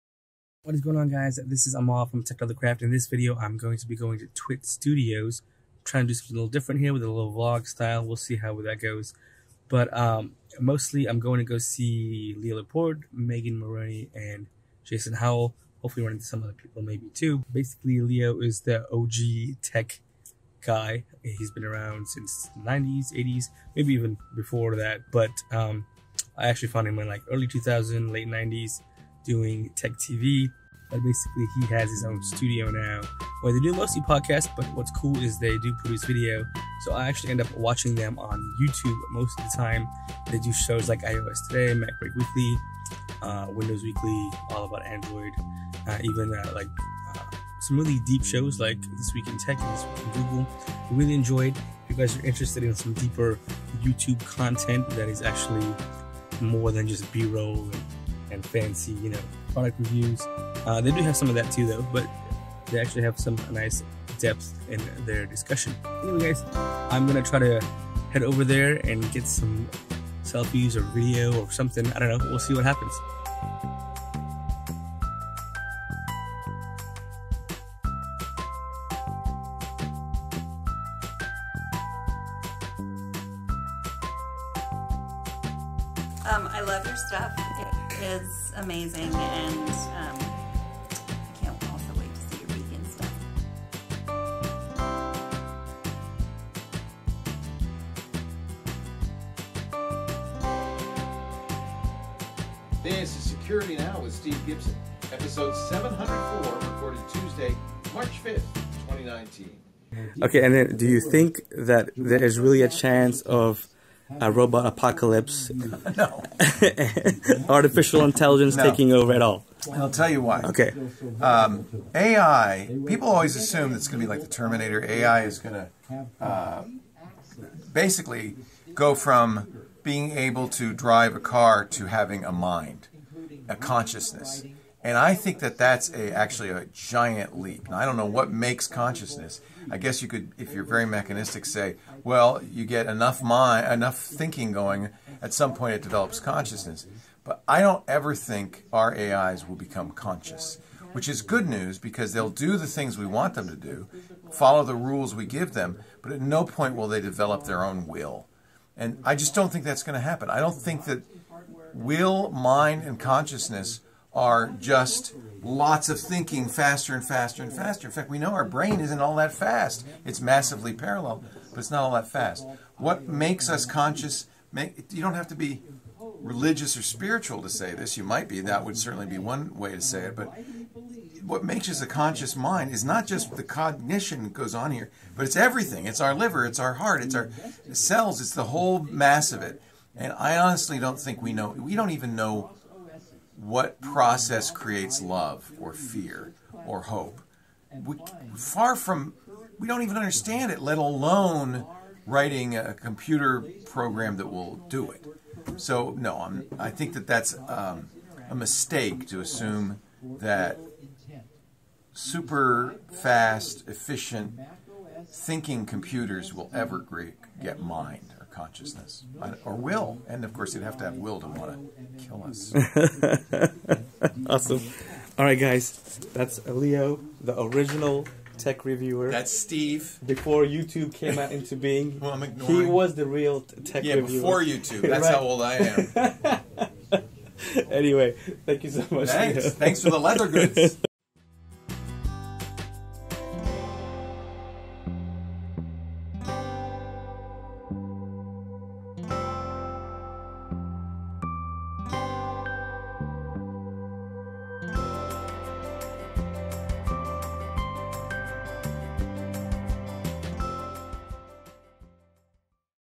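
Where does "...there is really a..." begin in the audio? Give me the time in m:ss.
1:51.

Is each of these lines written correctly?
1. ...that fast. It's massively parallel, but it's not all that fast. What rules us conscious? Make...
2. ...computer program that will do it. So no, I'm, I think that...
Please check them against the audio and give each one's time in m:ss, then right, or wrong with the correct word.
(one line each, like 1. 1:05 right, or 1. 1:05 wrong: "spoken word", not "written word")
1. 2:49 wrong: "makes", not "rules"
2. 3:22 right.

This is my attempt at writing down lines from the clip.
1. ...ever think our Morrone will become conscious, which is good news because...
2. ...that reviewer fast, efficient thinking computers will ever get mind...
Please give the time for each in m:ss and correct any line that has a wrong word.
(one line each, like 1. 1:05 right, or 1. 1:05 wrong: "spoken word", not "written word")
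1. 2:27 wrong: "AIs", not "Morrone"
2. 3:30 wrong: "super", not "reviewer".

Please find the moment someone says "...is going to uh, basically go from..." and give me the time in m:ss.
2:05.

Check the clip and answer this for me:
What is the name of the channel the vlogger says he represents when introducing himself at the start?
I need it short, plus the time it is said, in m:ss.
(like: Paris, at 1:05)
TechLeatherCraft, at 0:02.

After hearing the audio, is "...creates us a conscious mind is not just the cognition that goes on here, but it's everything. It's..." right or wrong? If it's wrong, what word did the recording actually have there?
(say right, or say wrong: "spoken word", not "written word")
wrong: "makes", not "creates".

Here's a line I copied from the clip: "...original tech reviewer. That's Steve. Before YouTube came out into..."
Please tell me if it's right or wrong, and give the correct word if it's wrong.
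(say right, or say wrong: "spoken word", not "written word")
right.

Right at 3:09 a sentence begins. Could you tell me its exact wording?
And I honestly don't think we know.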